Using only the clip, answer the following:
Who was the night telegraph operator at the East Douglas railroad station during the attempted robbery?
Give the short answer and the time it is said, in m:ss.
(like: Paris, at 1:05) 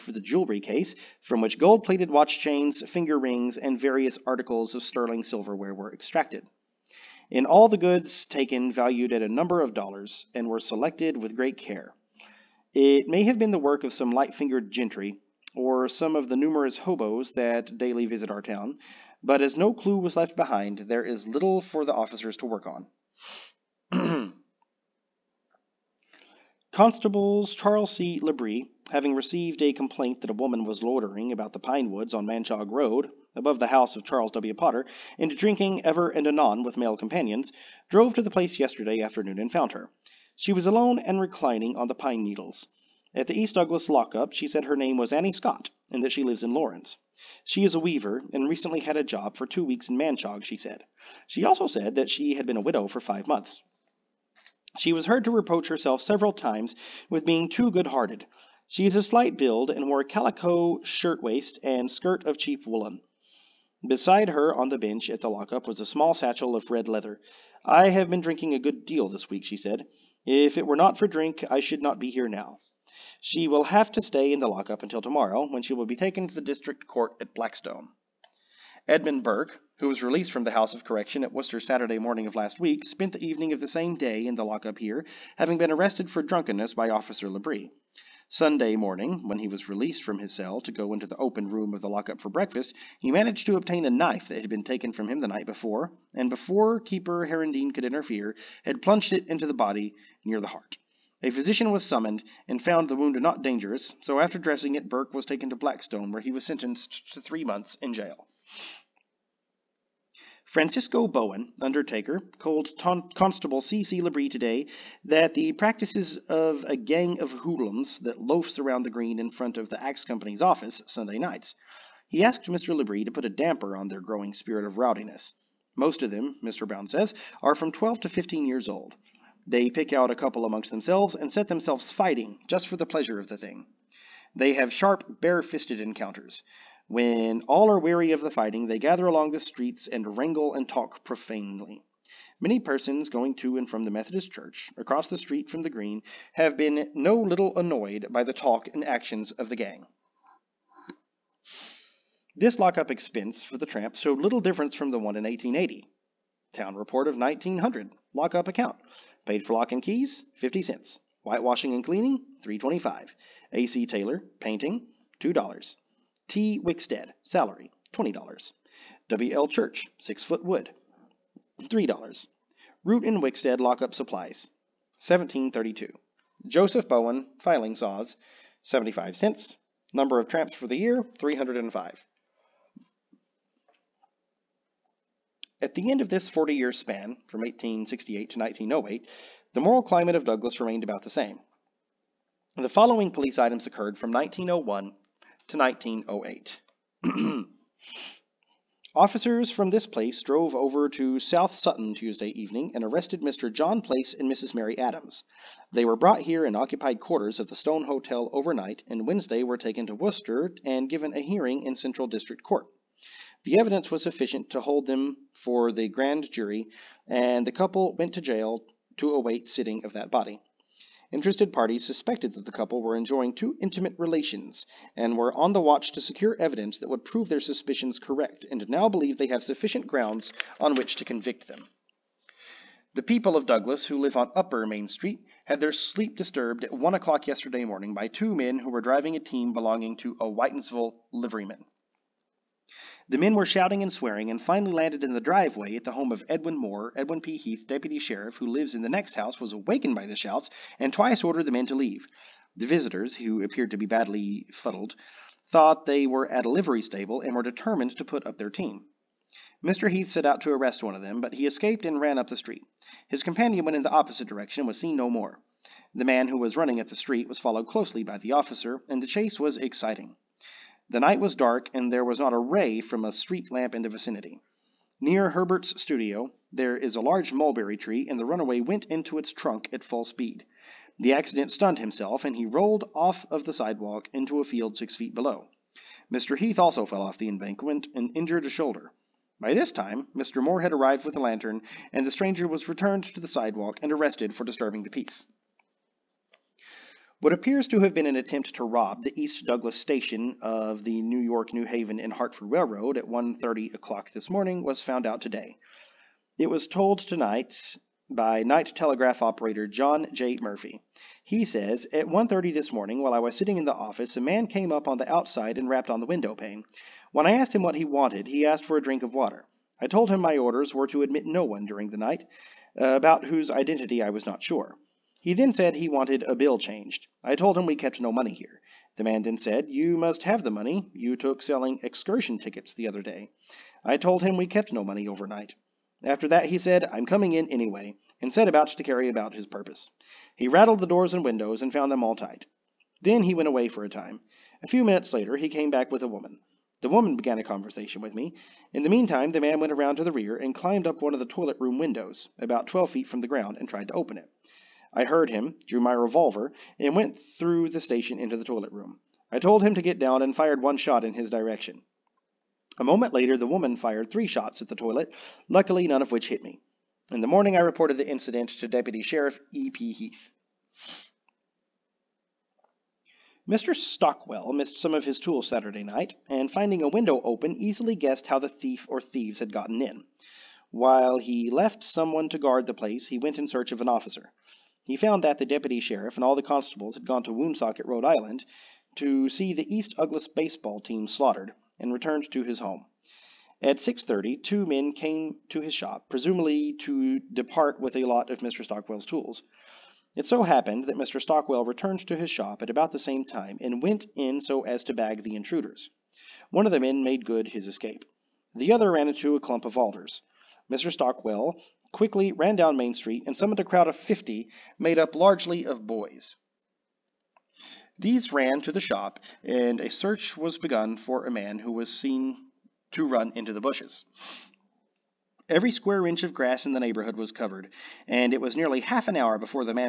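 John J. Murphy, at 5:09.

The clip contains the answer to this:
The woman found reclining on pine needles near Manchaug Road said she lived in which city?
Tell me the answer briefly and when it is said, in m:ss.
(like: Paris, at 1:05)
Lawrence, at 0:46.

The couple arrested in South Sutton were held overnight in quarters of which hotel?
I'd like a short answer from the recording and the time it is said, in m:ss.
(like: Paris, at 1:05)
the Stone Hotel, at 3:27.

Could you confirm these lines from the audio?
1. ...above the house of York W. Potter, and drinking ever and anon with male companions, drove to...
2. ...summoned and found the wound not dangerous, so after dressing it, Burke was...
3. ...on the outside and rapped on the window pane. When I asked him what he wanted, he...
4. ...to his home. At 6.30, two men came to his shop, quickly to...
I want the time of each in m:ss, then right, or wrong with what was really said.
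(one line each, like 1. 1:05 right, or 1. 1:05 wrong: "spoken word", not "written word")
1. 0:33 wrong: "Charles", not "York"
2. 1:41 right
3. 5:14 right
4. 6:32 wrong: "presumably", not "quickly".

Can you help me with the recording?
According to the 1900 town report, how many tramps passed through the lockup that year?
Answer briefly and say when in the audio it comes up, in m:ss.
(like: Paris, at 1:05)
305, at 3:01.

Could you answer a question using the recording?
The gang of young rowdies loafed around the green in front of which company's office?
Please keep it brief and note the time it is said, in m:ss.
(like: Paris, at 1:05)
the Axe Company, at 1:59.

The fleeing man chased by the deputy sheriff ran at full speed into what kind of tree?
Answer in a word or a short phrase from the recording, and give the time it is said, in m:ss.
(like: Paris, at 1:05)
mulberry tree, at 4:37.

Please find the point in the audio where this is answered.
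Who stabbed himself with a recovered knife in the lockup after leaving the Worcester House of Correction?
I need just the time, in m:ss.
1:18.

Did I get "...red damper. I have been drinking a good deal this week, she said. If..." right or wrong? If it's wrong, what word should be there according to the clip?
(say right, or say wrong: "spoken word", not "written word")
wrong: "leather", not "damper".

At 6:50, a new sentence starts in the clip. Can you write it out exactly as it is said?
Stockwell quickly ran down Main Street and summoned a crowd of 50, made up largely of boys.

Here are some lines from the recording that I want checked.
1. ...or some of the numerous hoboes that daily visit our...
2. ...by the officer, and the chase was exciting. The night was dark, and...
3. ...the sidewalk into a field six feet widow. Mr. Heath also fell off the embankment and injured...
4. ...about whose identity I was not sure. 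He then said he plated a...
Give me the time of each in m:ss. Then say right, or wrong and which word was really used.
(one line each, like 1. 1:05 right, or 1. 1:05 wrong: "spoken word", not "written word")
1. 0:15 right
2. 4:28 right
3. 4:43 wrong: "below", not "widow"
4. 5:22 wrong: "wanted", not "plated".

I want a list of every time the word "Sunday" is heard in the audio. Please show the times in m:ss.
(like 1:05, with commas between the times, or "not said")
1:28, 2:00.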